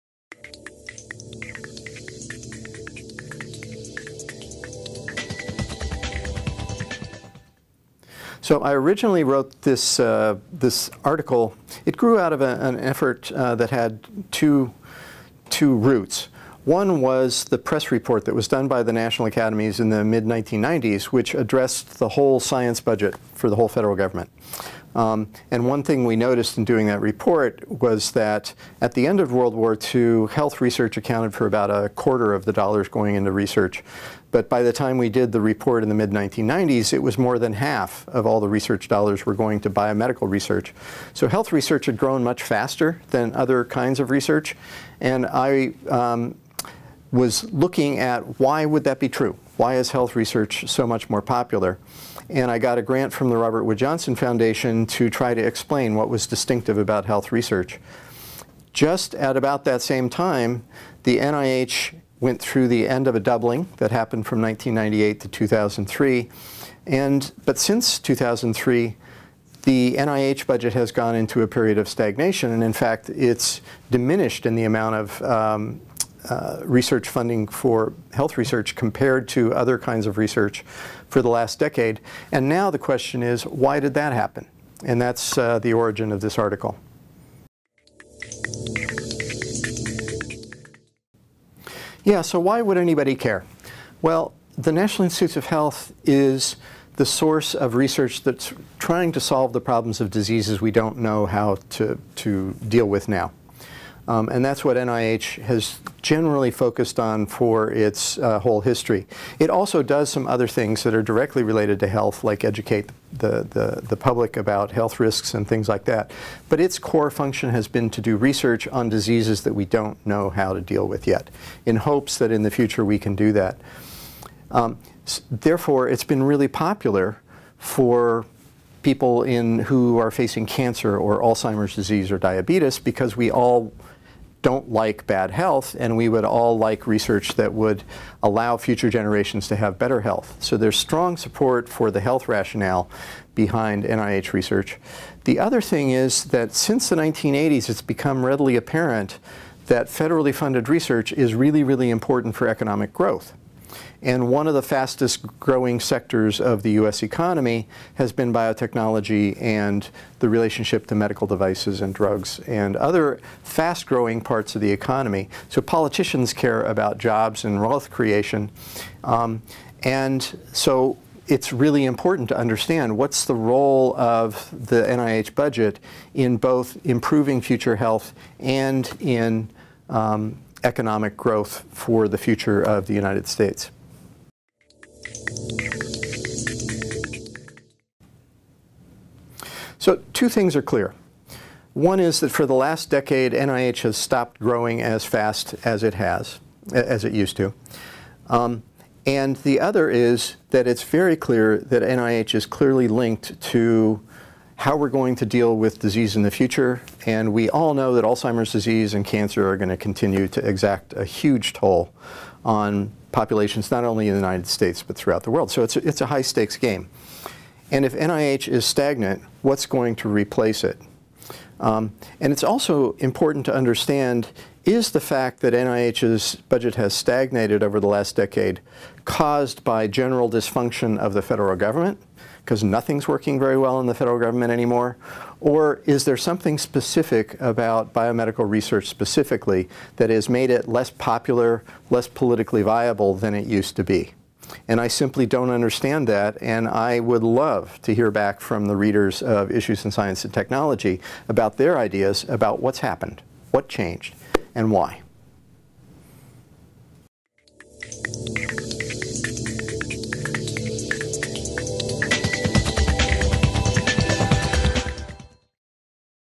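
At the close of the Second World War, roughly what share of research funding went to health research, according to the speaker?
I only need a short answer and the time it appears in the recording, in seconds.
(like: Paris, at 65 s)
a quarter, at 31 s.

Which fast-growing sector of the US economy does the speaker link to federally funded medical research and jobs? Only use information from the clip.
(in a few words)
biotechnology.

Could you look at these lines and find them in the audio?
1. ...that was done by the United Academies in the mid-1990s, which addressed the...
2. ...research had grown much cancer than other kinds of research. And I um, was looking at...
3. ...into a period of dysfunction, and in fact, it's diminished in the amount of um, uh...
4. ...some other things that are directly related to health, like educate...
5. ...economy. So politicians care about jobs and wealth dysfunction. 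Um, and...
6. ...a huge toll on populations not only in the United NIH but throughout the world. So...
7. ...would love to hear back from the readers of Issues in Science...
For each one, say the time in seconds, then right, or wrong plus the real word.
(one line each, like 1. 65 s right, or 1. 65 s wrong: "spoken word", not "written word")
1. 18 s wrong: "National", not "United"
2. 41 s wrong: "faster", not "cancer"
3. 71 s wrong: "stagnation", not "dysfunction"
4. 110 s right
5. 164 s wrong: "creation", not "dysfunction"
6. 210 s wrong: "States", not "NIH"
7. 246 s right.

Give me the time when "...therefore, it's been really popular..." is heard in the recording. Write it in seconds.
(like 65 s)
125 s.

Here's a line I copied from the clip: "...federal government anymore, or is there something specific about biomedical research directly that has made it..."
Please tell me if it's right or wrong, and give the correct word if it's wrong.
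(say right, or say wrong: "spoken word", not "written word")
wrong: "specifically", not "directly".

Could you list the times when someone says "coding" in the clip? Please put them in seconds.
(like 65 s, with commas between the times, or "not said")
not said.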